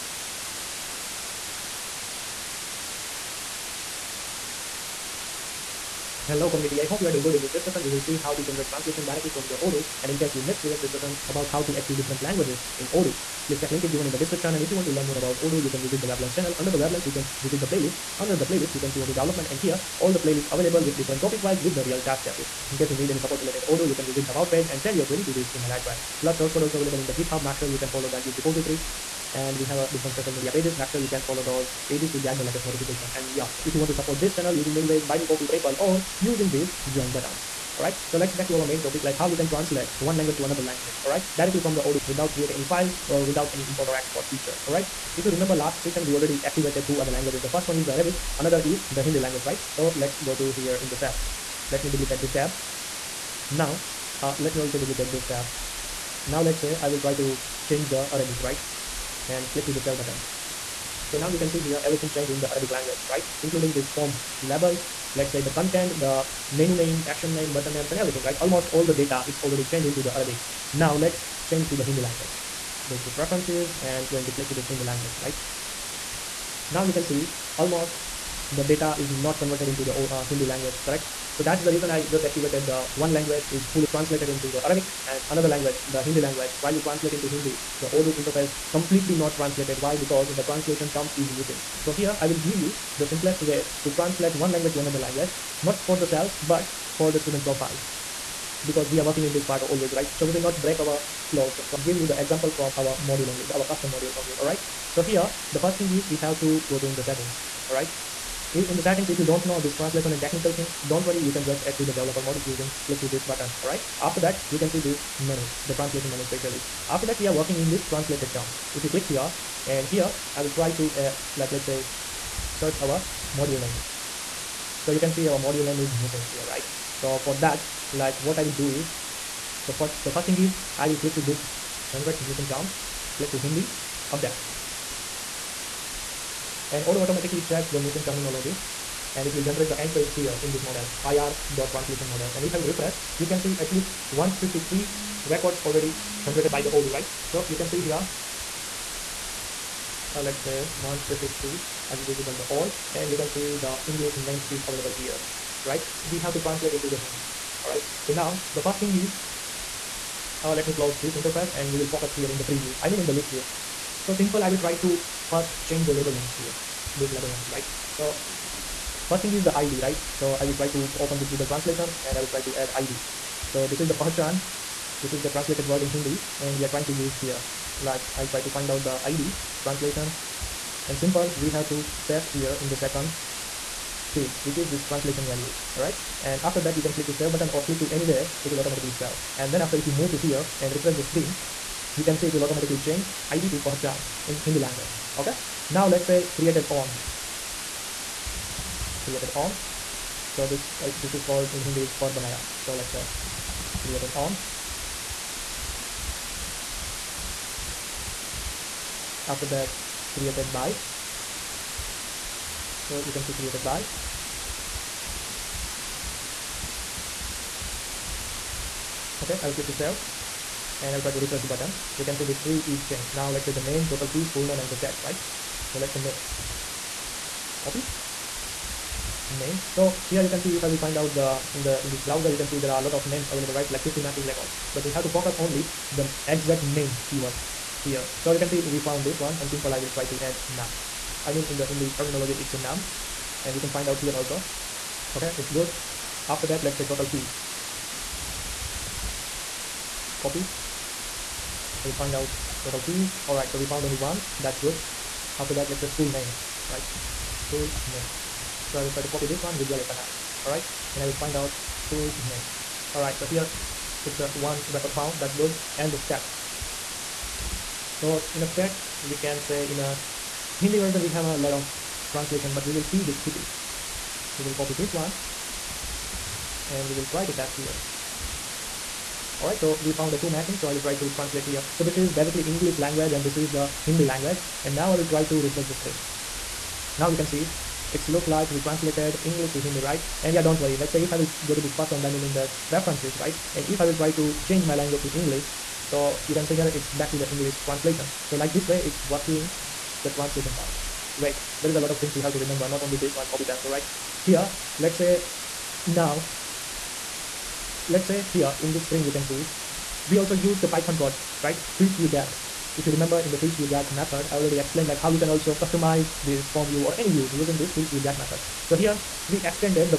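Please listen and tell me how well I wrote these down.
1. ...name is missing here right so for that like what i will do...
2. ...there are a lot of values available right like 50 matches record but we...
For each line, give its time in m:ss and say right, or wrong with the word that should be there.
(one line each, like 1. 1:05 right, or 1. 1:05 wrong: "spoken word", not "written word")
1. 2:05 right
2. 3:52 wrong: "names", not "values".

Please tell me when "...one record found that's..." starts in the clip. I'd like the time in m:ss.
4:24.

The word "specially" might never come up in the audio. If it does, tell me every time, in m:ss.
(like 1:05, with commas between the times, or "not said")
1:56.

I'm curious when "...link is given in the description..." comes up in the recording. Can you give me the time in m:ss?
0:13.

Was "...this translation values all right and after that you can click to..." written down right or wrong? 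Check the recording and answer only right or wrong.
right.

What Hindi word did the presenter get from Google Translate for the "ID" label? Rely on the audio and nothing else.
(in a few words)
Pahachan.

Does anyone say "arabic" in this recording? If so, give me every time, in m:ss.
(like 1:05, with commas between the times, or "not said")
0:47, 0:58, 1:02, 1:10, 1:24.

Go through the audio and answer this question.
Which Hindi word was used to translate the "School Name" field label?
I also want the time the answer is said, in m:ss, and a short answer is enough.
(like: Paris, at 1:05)
Vidyalaya, at 4:19.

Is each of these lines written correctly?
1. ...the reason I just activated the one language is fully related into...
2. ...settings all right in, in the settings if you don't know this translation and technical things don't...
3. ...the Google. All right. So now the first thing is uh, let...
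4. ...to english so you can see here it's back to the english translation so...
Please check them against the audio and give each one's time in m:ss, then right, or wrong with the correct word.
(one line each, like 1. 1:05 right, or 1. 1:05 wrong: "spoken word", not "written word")
1. 1:21 wrong: "translated", not "related"
2. 1:47 right
3. 2:36 wrong: "Hindi", not "Google"
4. 4:55 right.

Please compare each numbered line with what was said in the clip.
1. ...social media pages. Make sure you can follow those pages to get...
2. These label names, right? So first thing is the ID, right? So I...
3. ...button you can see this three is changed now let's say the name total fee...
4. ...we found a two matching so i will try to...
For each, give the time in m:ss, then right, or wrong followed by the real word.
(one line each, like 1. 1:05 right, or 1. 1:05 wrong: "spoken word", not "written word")
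1. 0:30 right
2. 2:46 right
3. 3:41 right
4. 4:39 right.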